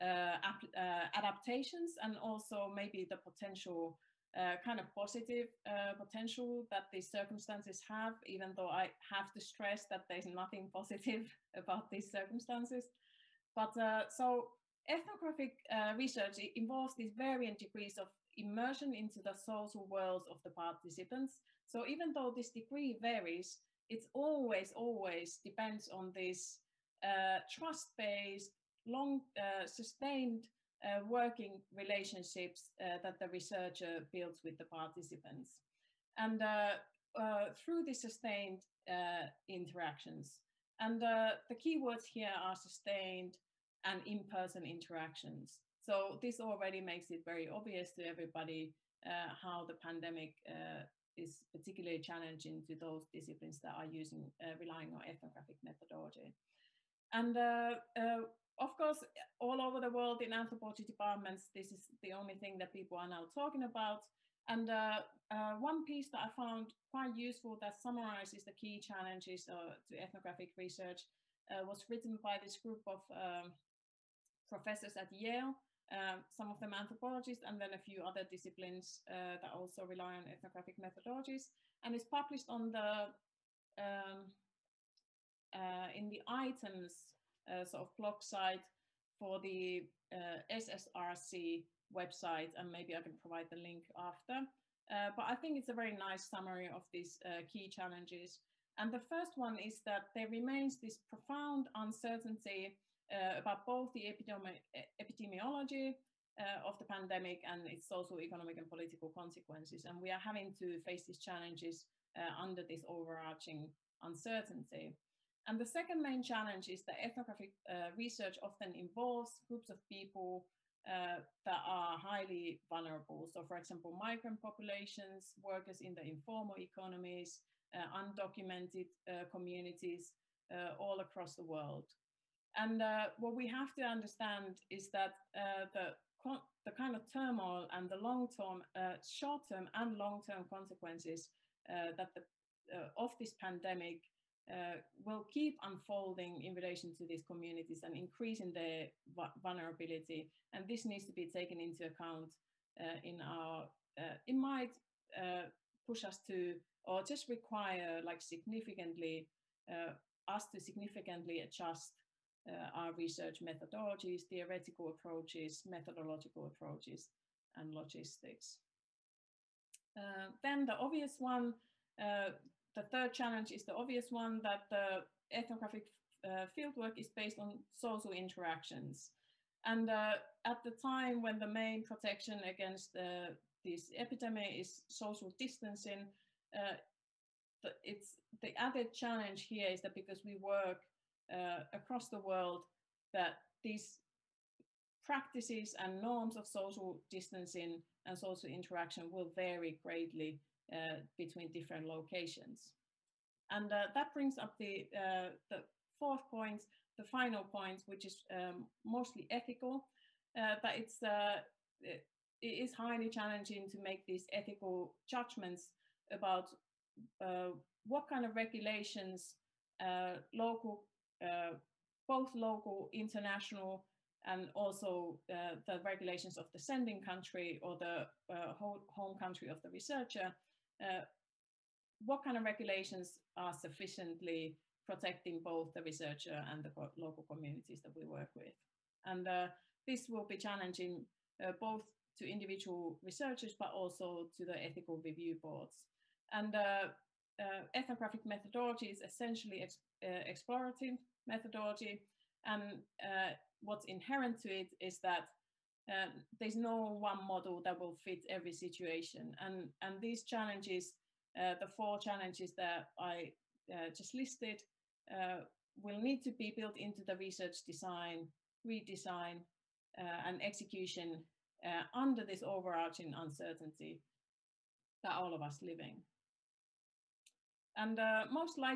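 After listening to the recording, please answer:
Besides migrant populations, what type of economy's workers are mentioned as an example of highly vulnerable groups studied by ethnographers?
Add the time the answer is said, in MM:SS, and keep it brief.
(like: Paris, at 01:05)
informal economies, at 02:06.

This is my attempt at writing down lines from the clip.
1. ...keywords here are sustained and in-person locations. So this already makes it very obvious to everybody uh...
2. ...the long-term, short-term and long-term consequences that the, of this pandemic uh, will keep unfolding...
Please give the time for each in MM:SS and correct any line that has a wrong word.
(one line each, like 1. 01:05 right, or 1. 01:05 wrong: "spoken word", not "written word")
1. 00:41 wrong: "interactions", not "locations"
2. 02:17 right.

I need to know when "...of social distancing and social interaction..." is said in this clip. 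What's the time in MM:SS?
03:16.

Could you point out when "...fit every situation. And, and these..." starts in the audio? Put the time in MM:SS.
04:17.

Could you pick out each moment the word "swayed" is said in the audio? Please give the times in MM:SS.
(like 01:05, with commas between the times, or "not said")
not said.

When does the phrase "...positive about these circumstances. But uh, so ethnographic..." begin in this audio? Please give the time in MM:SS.
00:10.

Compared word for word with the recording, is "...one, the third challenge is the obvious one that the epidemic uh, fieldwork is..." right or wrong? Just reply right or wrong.
wrong.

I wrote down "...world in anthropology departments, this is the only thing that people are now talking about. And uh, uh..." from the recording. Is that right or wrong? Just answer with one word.
right.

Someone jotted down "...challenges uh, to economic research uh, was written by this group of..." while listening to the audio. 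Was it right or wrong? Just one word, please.
wrong.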